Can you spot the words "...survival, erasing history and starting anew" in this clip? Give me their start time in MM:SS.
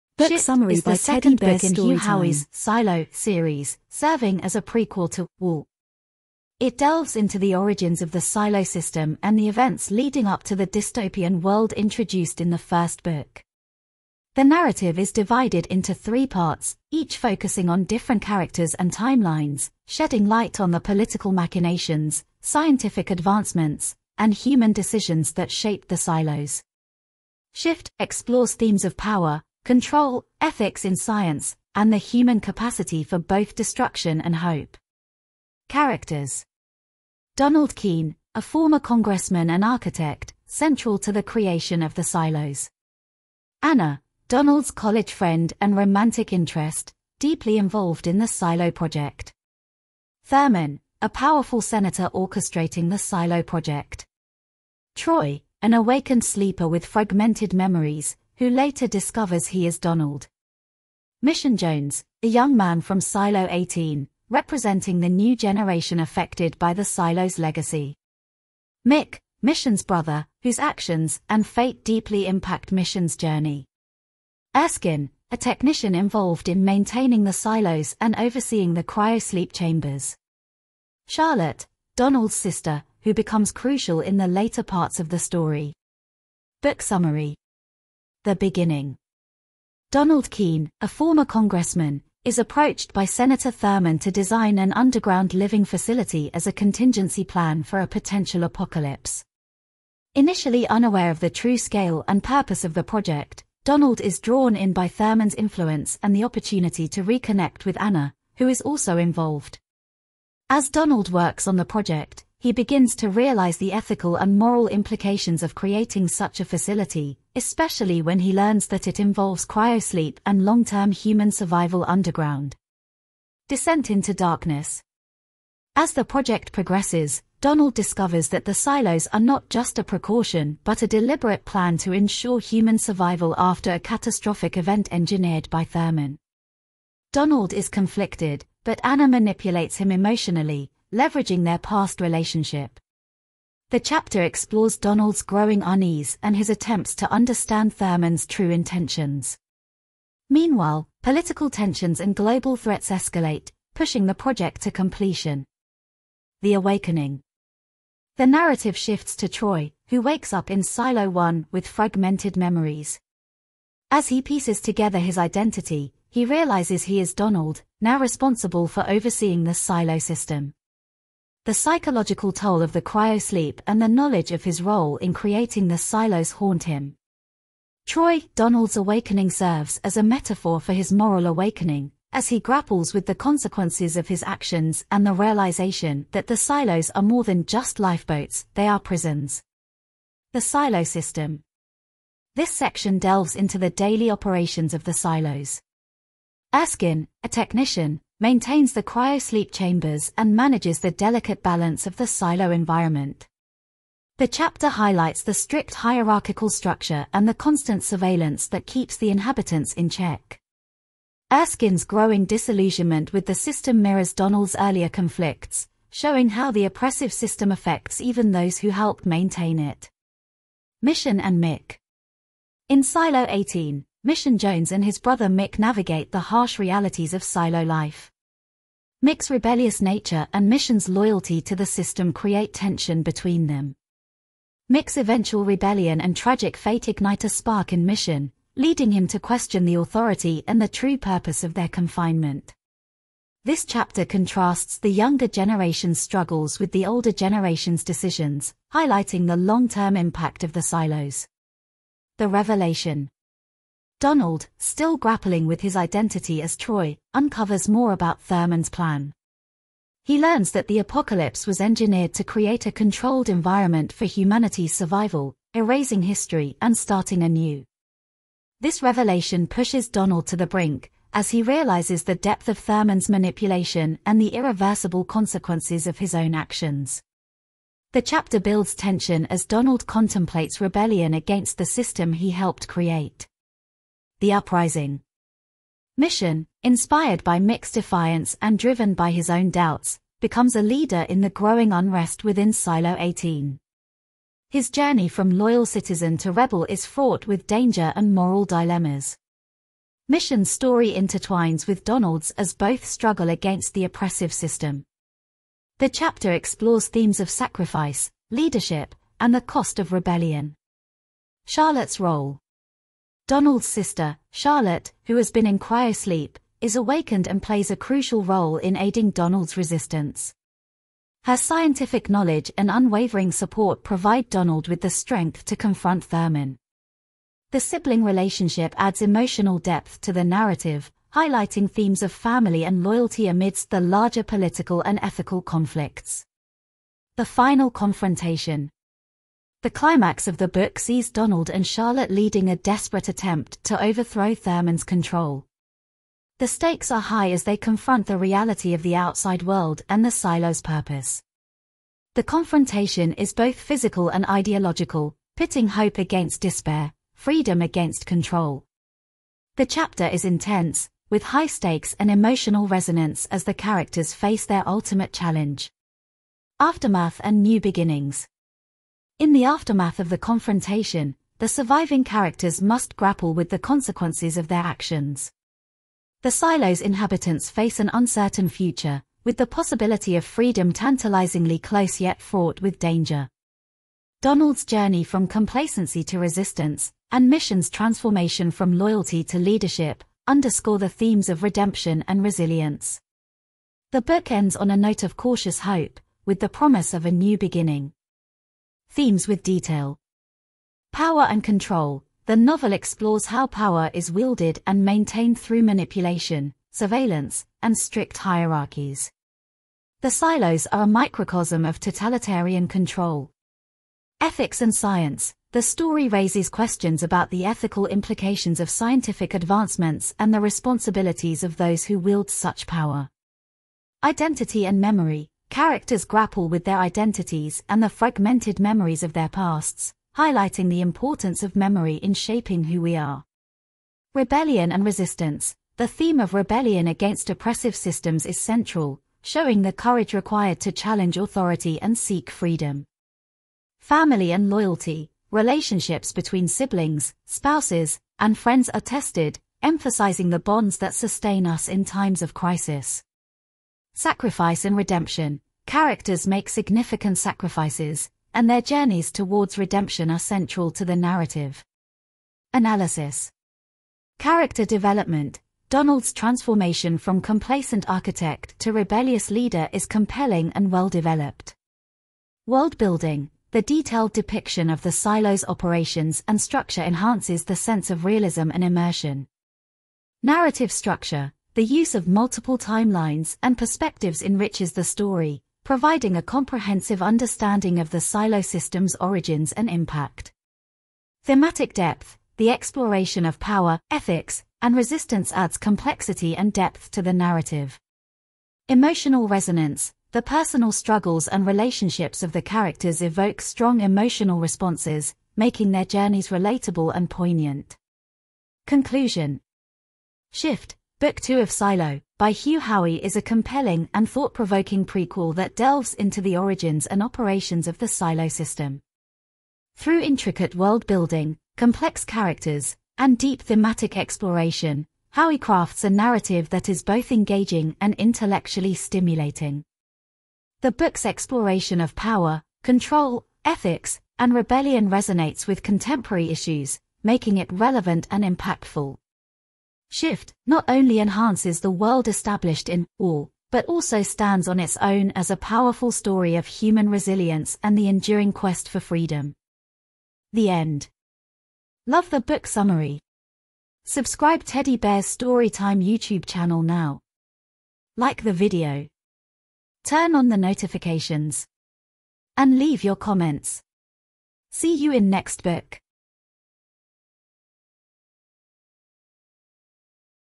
04:24.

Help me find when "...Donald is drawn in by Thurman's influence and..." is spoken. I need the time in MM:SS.
01:43.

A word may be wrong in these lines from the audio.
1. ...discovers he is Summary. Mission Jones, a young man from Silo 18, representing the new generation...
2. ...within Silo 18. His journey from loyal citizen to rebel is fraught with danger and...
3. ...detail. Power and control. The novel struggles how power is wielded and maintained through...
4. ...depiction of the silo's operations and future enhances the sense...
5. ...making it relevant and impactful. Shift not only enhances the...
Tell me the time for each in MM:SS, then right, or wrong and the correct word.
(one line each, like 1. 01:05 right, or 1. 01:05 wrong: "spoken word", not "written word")
1. 00:58 wrong: "Donald", not "Summary"
2. 04:52 right
3. 06:39 wrong: "explores", not "struggles"
4. 07:54 wrong: "structure", not "future"
5. 08:57 right.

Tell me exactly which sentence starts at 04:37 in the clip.
The chapter builds tension as Donald contemplates rebellion against the system he helped create.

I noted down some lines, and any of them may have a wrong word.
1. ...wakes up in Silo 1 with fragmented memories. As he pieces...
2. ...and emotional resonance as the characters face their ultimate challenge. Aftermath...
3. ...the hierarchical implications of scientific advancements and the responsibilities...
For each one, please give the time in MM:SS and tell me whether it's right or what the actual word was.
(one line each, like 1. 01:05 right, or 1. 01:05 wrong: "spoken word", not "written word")
1. 02:40 right
2. 06:01 right
3. 06:57 wrong: "ethical", not "hierarchical".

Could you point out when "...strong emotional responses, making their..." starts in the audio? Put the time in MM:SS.
08:23.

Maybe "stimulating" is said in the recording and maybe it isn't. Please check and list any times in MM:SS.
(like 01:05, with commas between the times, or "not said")
08:48.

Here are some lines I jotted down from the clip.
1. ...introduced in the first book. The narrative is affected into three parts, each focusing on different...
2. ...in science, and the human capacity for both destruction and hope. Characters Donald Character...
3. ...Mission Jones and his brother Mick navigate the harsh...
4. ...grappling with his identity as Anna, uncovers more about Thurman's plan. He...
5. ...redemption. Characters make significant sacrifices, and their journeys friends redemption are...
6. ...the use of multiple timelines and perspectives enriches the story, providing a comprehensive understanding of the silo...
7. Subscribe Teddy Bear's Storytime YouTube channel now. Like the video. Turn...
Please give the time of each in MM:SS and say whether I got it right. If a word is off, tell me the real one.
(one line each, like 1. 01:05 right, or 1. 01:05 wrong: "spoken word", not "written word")
1. 00:11 wrong: "divided", not "affected"
2. 00:30 wrong: "Keene", not "Character"
3. 03:44 right
4. 04:14 wrong: "Troy", not "Anna"
5. 07:34 wrong: "towards", not "friends"
6. 08:01 right
7. 09:13 right.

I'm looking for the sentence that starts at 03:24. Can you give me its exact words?
The chapter highlights the strict hierarchical structure and the constant surveillance that keeps the inhabitants in check.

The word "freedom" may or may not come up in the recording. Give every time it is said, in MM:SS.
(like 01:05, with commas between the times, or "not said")
05:57, 06:20, 07:22, 09:08.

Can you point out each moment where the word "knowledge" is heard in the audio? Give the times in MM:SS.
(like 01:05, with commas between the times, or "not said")
02:53, 05:22.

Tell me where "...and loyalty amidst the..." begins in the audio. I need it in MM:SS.
05:32.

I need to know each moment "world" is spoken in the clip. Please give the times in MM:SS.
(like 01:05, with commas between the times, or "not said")
00:11, 05:49, 07:52, 08:40, 09:01.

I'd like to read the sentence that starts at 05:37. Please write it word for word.
The final confrontation, the climax of the book sees Donald and Charlotte leading a desperate attempt to overthrow Thurman's control.